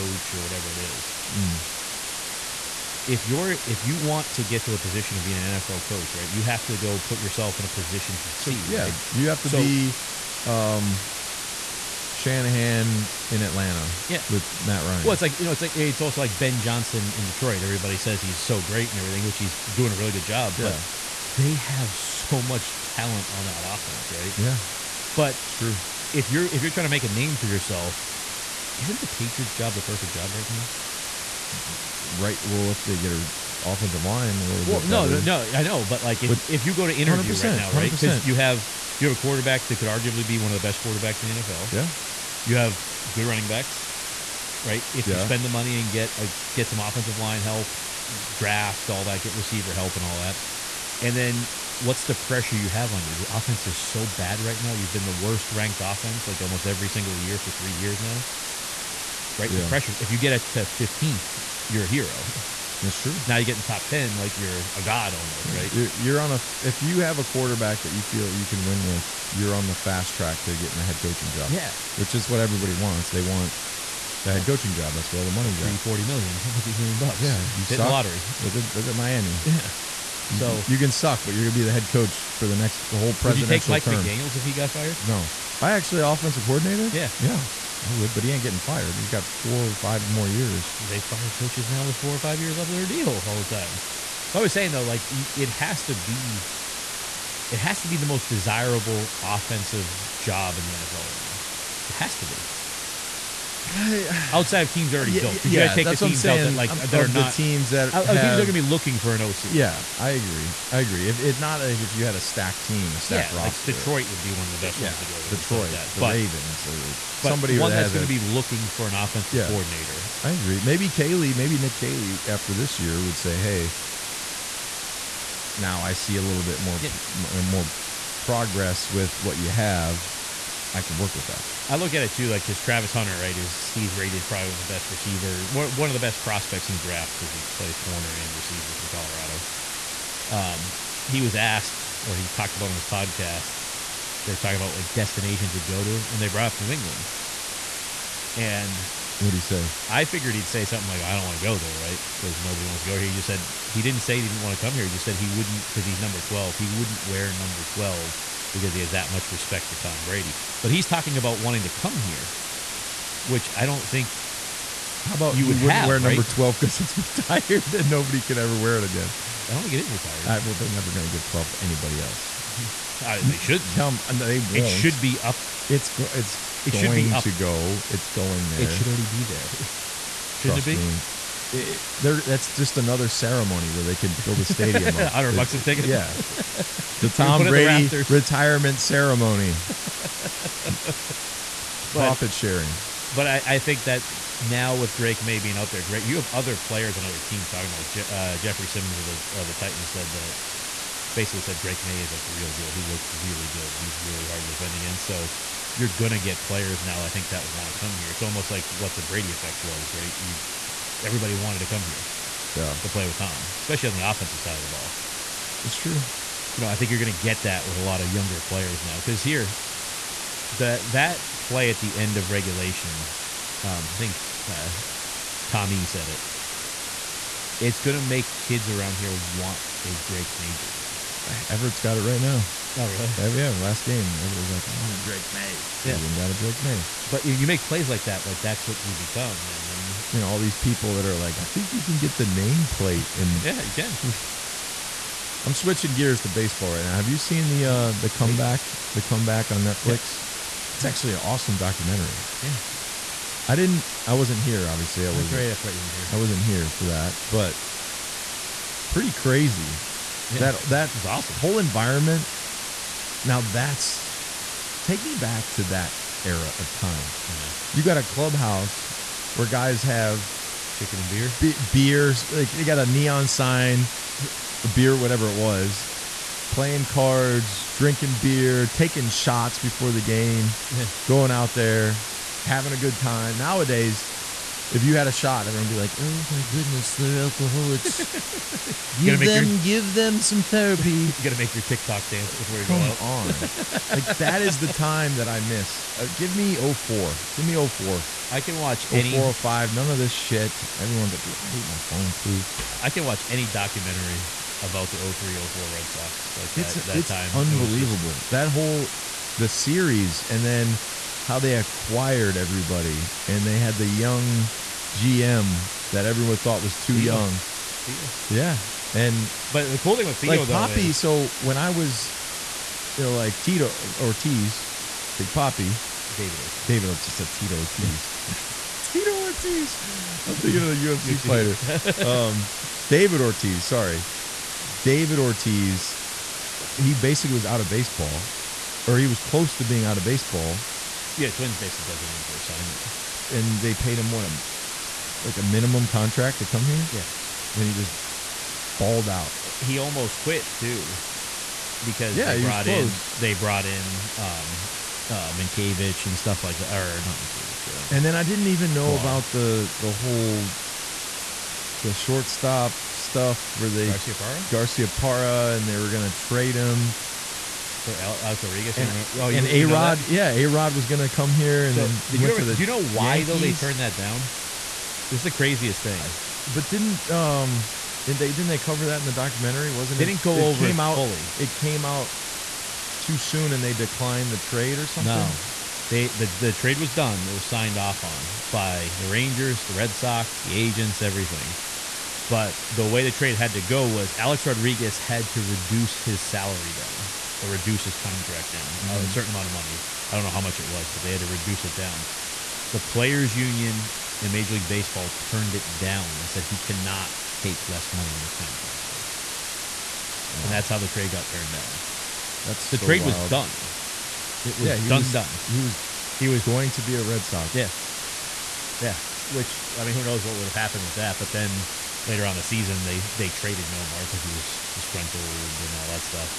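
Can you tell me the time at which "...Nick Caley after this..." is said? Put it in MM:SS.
02:01.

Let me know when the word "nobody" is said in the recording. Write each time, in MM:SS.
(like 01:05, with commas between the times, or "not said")
02:32, 02:47.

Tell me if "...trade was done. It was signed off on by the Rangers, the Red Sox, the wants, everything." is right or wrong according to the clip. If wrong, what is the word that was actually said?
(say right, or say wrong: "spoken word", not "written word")
wrong: "agents", not "wants".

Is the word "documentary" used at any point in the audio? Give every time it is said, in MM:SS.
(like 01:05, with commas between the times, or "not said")
04:11, 05:03, 06:19.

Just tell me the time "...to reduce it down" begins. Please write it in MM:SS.
06:41.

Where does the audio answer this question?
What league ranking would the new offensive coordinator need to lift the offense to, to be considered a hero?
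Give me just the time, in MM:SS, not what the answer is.
01:00.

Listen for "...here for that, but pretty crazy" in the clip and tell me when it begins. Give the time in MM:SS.
04:16.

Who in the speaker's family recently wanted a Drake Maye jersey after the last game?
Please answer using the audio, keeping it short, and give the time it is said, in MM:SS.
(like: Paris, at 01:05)
Everett, at 03:51.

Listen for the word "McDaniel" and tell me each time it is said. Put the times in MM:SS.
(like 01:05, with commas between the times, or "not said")
01:24.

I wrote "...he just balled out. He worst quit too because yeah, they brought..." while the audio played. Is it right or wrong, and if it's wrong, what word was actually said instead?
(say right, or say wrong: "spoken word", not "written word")
wrong: "almost", not "worst".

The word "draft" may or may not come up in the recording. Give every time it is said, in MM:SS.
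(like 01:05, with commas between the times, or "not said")
00:48, 02:16.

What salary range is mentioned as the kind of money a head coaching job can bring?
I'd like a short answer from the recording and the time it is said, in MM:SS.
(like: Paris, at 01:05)
40 to 50 million, at 01:15.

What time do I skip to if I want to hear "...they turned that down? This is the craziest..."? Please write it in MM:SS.
06:13.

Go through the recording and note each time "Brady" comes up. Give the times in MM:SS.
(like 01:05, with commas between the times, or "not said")
02:40, 03:07, 03:29.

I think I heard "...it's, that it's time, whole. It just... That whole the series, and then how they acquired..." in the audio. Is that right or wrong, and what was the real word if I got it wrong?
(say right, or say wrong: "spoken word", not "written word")
wrong: "unbelievable", not "whole".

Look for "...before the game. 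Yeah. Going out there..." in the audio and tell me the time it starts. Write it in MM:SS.
04:39.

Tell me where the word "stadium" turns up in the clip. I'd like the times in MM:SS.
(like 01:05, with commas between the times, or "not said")
03:04.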